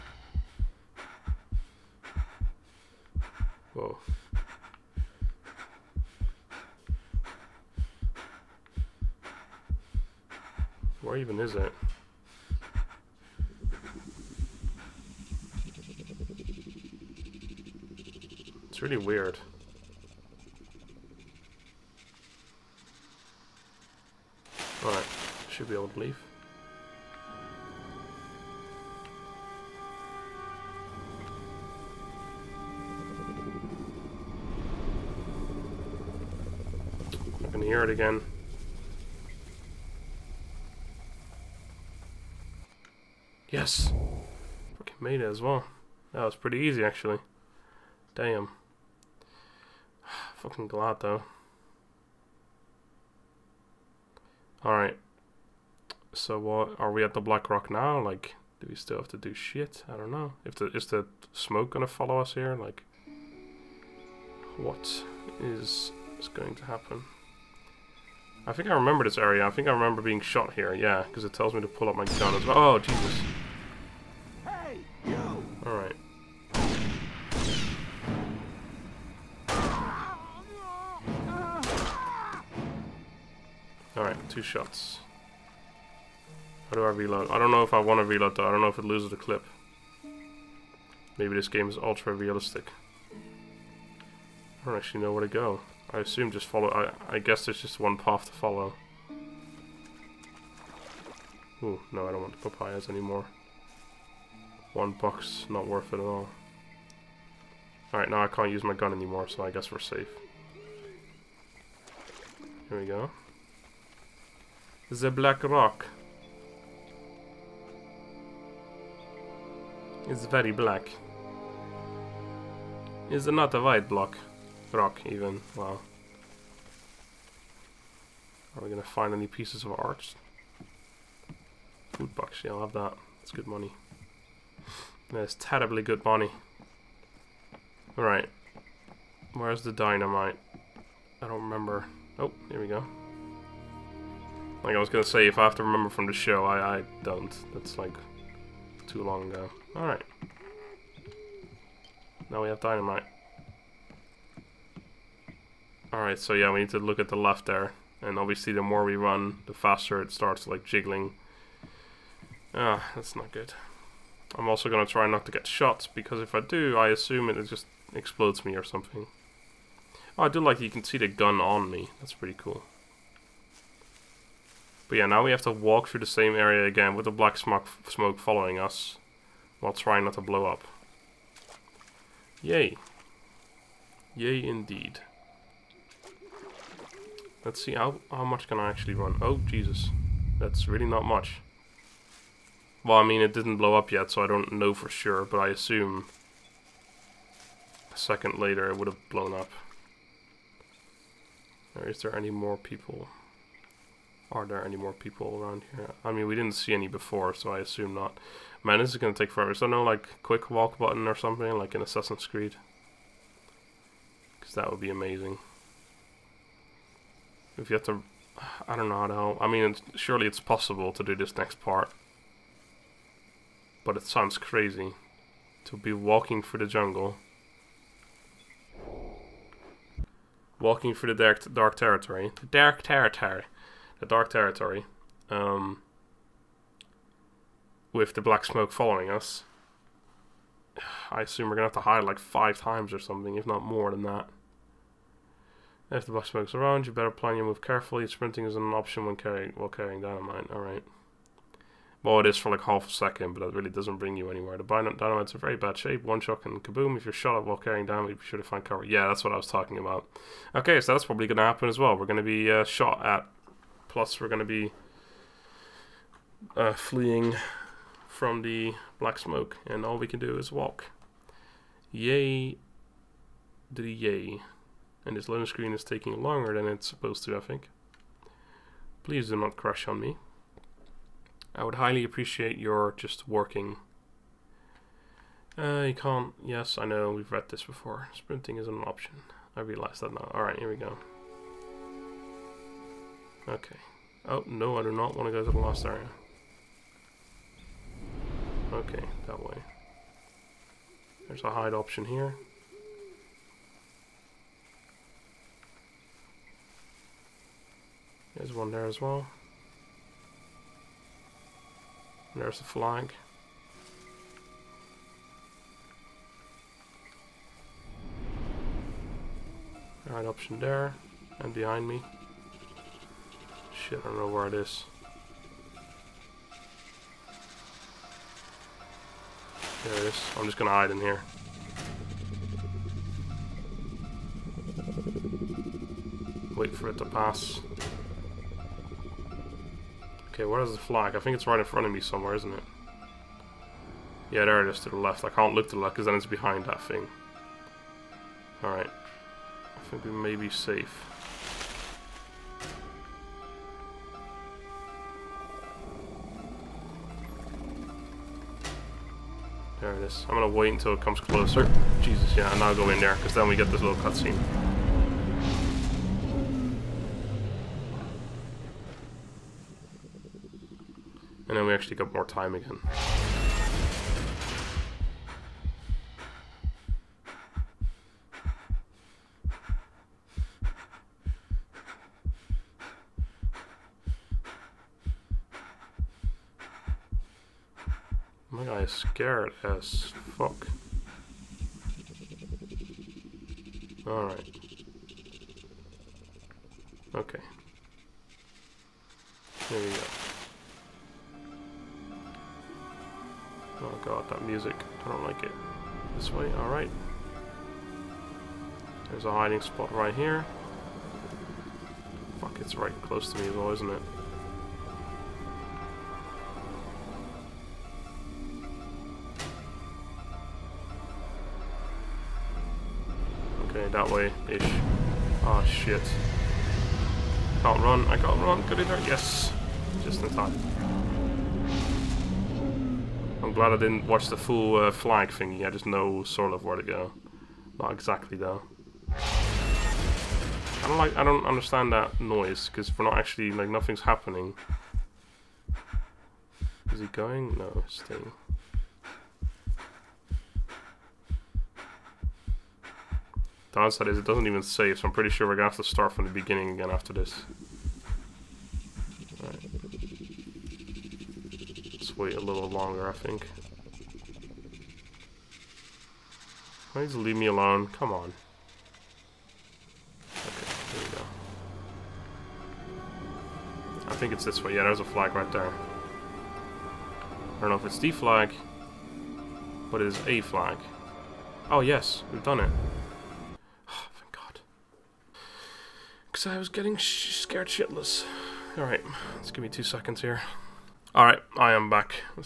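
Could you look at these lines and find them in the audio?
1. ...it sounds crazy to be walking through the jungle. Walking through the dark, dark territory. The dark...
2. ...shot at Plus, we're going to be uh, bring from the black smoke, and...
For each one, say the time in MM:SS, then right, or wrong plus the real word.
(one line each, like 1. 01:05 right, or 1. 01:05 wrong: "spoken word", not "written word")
1. 03:43 right
2. 04:22 wrong: "fleeing", not "bring".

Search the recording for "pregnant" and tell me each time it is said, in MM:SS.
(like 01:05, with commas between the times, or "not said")
not said.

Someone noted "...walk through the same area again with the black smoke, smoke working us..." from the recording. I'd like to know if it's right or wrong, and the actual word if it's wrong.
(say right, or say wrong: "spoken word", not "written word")
wrong: "following", not "working".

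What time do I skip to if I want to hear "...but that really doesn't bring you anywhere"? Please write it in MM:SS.
04:13.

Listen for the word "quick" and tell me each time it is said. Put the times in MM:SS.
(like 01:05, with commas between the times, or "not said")
03:30.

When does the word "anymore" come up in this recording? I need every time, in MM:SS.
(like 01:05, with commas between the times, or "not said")
01:42, 01:48.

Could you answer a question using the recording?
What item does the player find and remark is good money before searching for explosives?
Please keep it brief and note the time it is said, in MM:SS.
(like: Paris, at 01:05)
Food box, at 02:11.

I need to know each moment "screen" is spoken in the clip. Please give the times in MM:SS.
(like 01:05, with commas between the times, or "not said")
04:35.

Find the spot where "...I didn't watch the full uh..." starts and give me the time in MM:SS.
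07:13.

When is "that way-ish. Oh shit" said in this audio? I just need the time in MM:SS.
07:03.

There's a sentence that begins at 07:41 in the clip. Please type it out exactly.
Let's wait a little longer, I think.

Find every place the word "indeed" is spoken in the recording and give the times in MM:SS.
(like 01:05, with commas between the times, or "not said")
03:04.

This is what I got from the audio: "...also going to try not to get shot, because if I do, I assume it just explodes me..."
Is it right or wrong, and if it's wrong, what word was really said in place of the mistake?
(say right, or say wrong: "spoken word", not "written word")
right.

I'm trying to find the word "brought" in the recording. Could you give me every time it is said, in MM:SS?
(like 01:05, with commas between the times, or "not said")
not said.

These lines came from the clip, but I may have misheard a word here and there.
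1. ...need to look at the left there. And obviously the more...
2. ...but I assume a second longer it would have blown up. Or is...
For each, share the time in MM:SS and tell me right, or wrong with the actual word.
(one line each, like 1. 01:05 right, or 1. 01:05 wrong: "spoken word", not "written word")
1. 02:36 right
2. 03:15 wrong: "later", not "longer".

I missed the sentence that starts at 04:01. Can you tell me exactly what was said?
I assume we're gonna have to hide like five times or something, if not more than that.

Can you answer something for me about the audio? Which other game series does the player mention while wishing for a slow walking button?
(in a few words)
Assassin's Creed.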